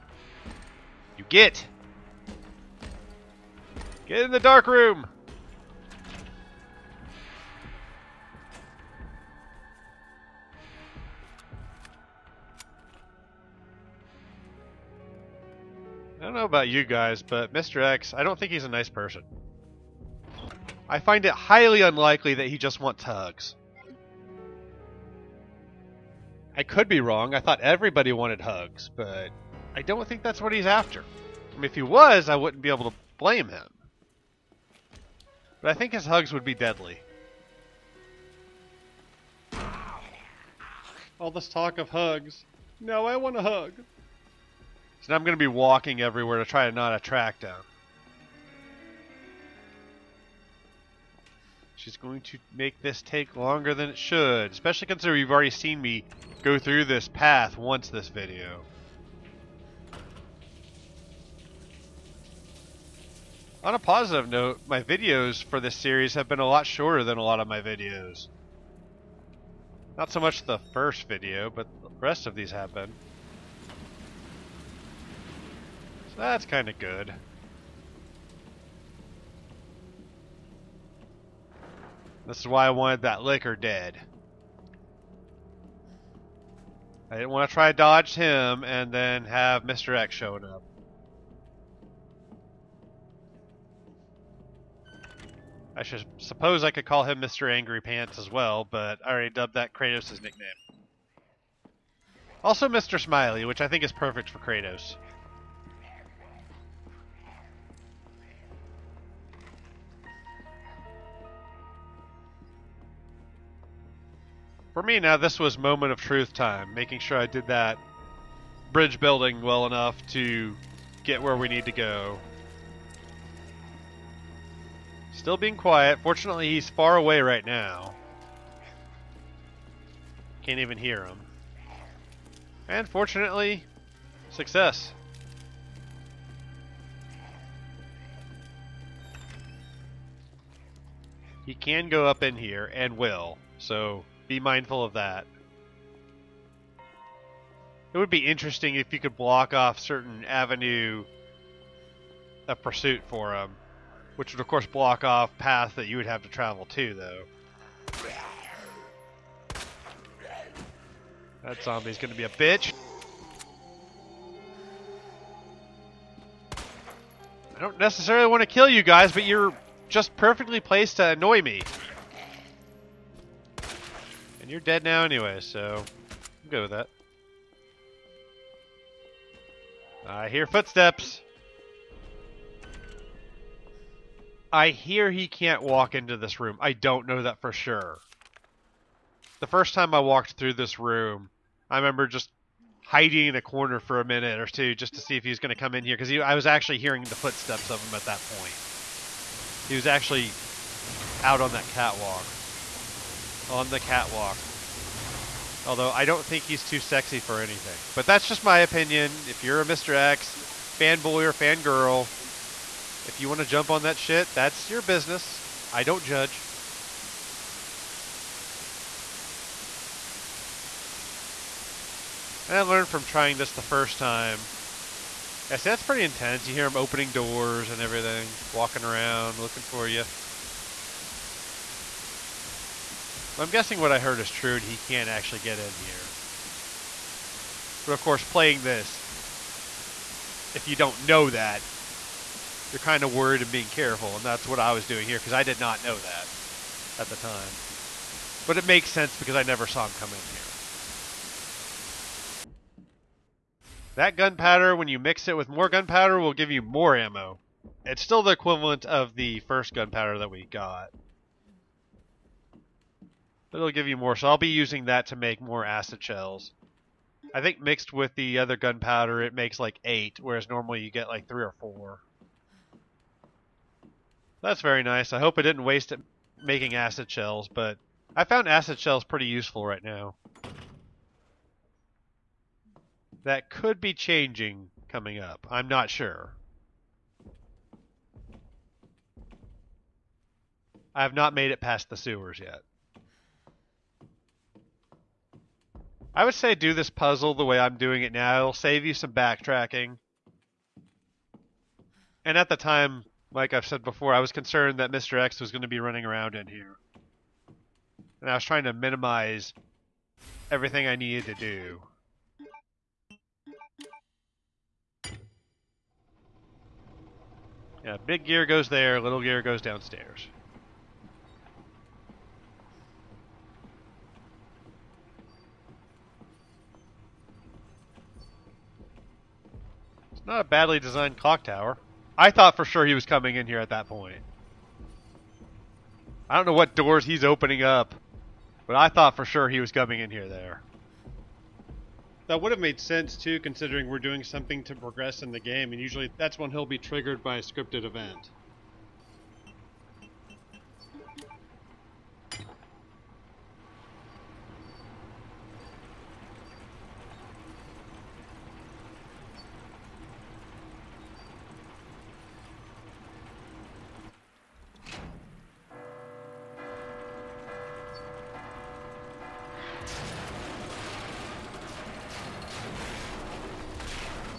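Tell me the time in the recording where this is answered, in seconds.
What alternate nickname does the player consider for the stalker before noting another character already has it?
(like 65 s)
97 s.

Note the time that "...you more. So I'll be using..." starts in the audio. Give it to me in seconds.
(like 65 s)
263 s.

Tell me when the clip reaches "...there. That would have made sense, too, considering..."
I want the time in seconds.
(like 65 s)
340 s.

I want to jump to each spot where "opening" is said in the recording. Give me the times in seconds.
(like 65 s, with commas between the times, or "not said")
226 s, 337 s.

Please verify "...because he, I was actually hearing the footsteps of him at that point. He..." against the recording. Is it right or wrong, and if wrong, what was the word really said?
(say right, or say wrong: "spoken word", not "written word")
right.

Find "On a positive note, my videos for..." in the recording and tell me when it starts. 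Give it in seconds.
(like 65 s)
63 s.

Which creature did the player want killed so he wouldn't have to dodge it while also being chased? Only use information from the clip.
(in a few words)
licker.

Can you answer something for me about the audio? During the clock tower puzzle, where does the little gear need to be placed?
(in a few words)
downstairs.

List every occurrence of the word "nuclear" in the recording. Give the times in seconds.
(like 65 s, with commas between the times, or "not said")
not said.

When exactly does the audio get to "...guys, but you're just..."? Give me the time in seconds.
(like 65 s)
168 s.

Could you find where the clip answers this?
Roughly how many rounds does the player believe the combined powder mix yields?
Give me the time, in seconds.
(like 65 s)
269 s.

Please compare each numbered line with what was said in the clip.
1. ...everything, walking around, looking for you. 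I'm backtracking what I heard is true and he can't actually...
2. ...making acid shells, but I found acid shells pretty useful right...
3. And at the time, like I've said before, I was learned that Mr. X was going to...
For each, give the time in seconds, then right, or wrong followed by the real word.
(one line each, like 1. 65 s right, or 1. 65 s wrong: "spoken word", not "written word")
1. 227 s wrong: "guessing", not "backtracking"
2. 276 s right
3. 302 s wrong: "concerned", not "learned".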